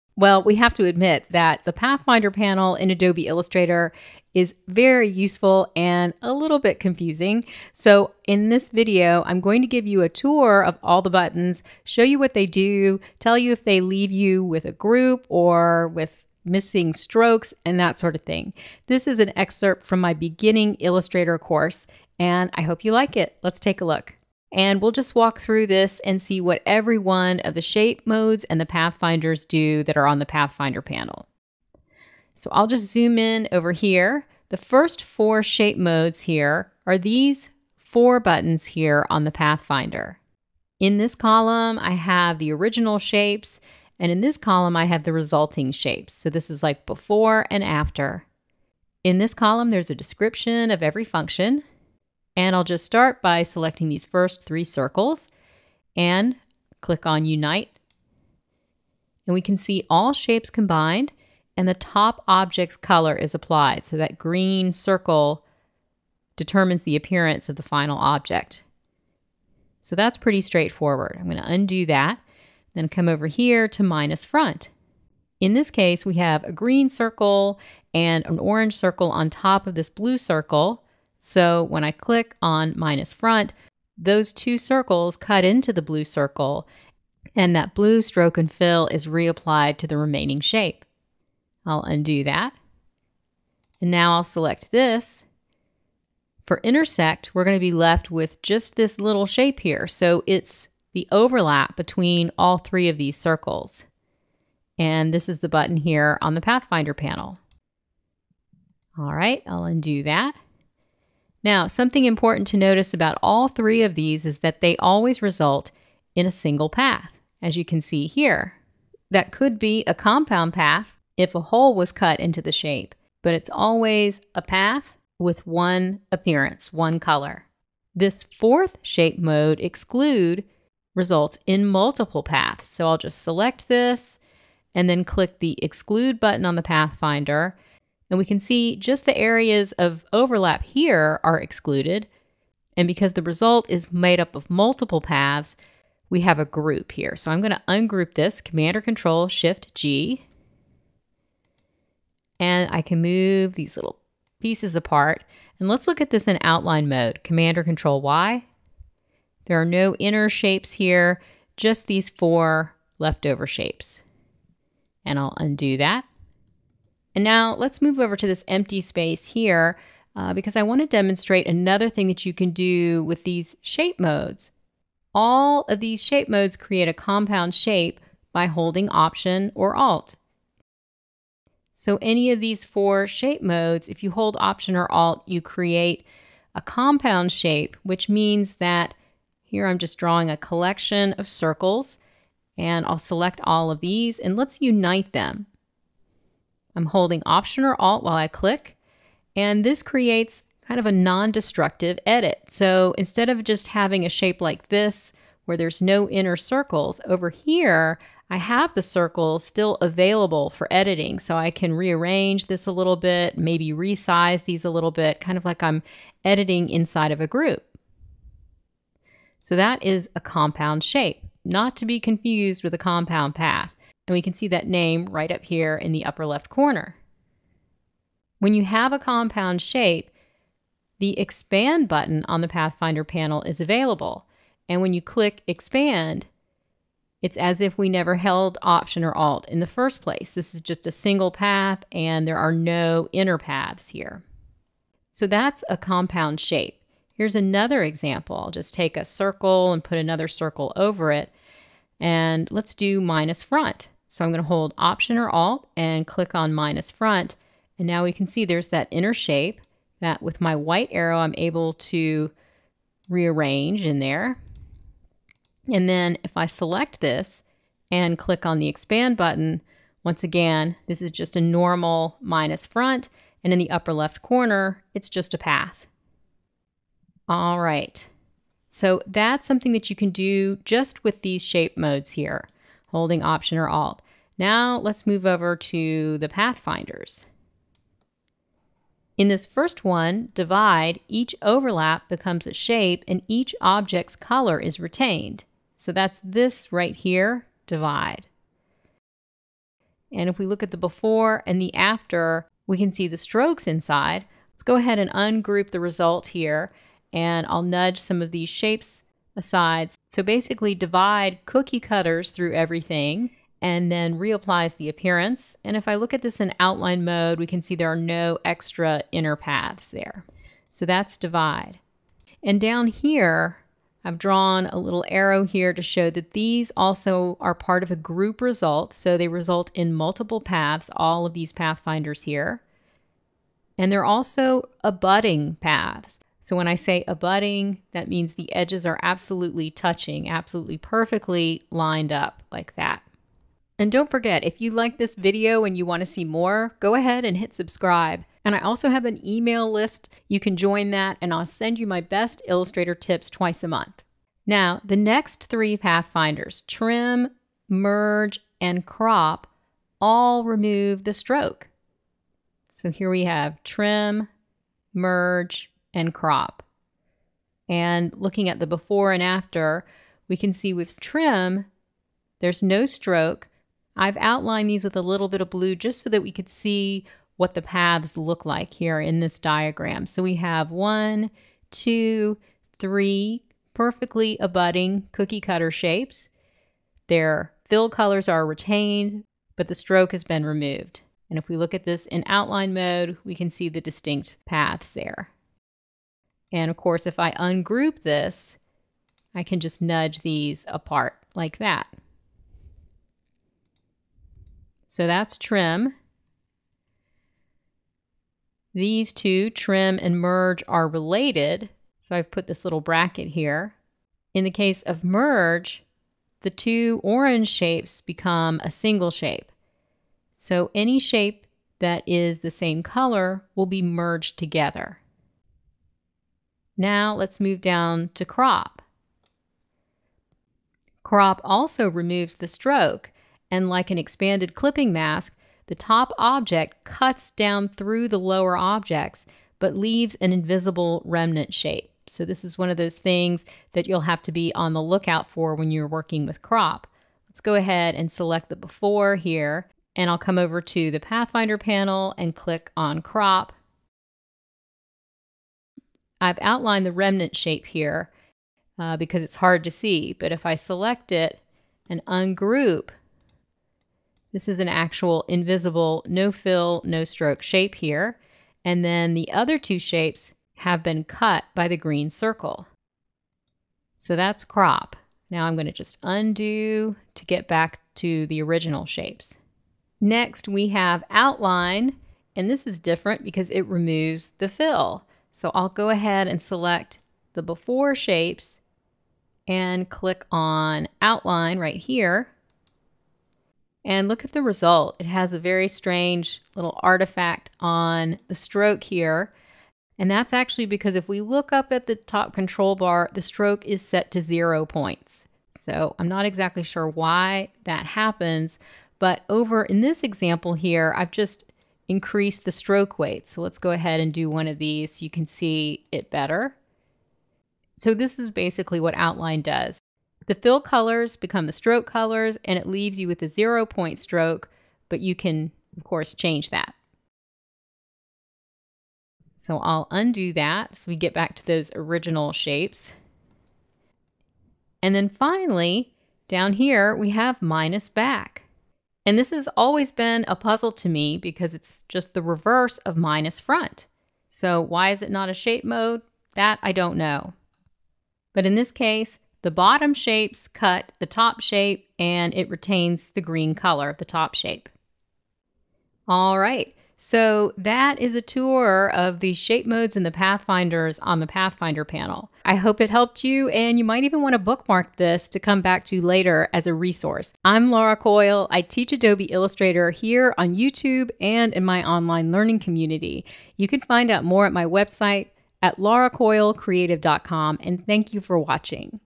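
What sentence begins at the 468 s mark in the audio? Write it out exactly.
And then the other two shapes have been cut by the green circle.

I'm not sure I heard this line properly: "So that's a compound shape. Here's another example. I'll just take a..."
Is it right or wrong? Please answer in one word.
right.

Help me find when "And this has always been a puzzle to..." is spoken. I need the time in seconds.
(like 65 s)
539 s.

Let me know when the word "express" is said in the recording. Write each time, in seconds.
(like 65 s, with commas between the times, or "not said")
not said.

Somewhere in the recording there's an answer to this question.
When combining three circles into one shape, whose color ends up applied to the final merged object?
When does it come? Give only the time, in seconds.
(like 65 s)
61 s.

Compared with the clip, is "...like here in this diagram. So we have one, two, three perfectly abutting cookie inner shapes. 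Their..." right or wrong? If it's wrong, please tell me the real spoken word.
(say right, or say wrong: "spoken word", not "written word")
wrong: "cutter", not "inner".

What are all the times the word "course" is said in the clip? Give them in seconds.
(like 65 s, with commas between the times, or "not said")
21 s, 396 s, 525 s.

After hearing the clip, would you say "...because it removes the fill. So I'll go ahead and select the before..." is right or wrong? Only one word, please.
right.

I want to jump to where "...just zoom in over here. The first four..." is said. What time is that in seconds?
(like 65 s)
32 s.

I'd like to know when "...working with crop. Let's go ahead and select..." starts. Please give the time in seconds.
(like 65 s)
445 s.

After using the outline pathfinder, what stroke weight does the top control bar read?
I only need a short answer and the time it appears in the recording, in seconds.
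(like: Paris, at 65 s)
0 points, at 504 s.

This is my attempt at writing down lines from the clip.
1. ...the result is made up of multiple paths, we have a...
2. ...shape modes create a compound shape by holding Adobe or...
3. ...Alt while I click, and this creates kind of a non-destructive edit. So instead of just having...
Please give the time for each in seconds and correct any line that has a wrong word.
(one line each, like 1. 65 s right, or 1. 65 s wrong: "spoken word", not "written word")
1. 143 s right
2. 176 s wrong: "Option", not "Adobe"
3. 197 s right.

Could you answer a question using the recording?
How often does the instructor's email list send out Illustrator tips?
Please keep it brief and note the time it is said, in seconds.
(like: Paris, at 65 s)
Twice a month, at 353 s.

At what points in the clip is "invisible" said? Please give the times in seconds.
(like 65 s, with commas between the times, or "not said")
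440 s, 465 s.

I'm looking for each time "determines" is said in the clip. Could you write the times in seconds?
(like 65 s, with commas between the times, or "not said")
66 s.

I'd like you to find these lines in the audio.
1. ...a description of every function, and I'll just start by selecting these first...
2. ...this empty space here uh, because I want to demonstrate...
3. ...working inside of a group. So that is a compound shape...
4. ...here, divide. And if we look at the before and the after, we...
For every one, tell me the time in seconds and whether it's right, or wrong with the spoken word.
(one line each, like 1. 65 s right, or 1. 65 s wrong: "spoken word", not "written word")
1. 49 s right
2. 168 s right
3. 216 s wrong: "editing", not "working"
4. 296 s right.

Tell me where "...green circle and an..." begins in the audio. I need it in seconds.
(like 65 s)
76 s.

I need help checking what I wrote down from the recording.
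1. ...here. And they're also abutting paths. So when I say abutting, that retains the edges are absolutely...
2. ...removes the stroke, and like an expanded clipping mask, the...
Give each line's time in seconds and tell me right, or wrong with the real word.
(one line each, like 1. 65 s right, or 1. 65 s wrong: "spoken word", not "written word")
1. 332 s wrong: "means", not "retains"
2. 431 s right.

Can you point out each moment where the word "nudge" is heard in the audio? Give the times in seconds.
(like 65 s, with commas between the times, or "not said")
307 s, 399 s.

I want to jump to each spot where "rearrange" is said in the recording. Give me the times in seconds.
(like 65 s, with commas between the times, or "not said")
211 s, 263 s.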